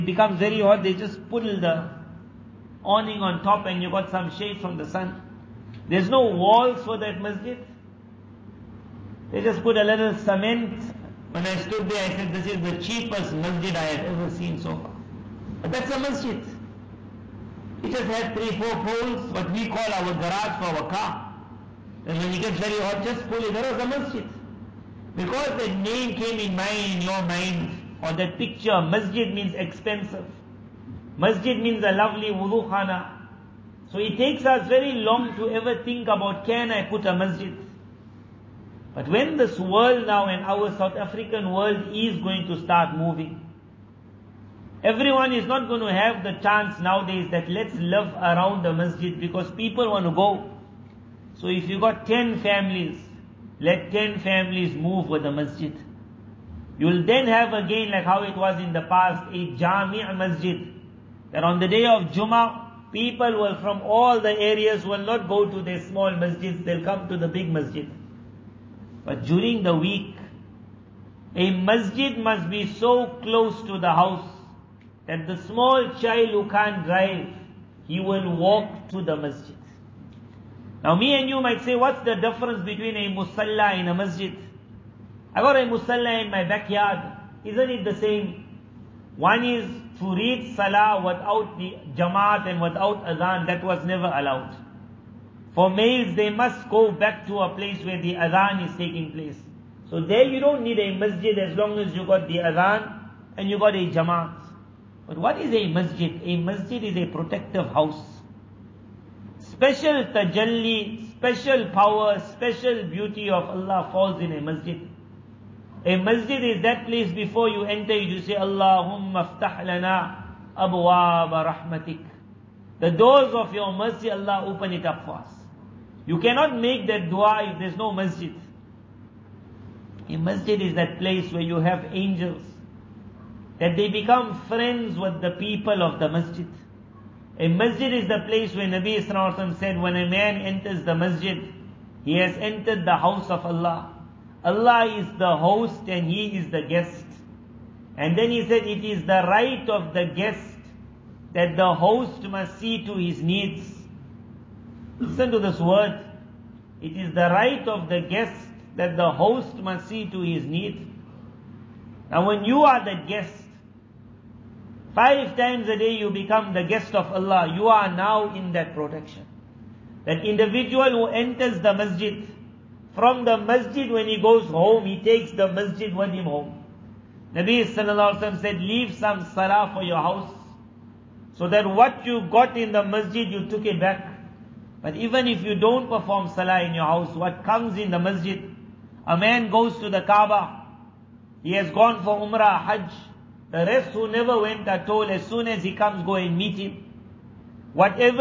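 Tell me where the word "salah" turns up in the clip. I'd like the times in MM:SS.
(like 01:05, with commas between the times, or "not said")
01:30, 02:59, 03:06.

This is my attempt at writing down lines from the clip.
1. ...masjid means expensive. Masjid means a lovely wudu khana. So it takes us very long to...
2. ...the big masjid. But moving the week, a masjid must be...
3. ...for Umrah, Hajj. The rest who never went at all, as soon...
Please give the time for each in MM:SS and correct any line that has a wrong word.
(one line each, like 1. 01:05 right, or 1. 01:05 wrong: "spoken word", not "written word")
1. 00:28 right
2. 01:07 wrong: "during", not "moving"
3. 03:12 right.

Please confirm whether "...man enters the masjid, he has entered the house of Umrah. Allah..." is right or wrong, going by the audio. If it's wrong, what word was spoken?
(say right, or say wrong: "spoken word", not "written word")
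wrong: "Allah", not "Umrah".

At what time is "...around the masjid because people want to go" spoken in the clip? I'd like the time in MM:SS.
00:48.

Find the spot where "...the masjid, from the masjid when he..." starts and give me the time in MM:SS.
02:51.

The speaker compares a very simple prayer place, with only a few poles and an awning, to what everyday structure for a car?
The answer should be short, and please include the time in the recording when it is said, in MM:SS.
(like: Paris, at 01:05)
garage, at 00:20.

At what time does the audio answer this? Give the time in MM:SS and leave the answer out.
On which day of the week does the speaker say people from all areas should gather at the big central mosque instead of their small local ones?
01:02.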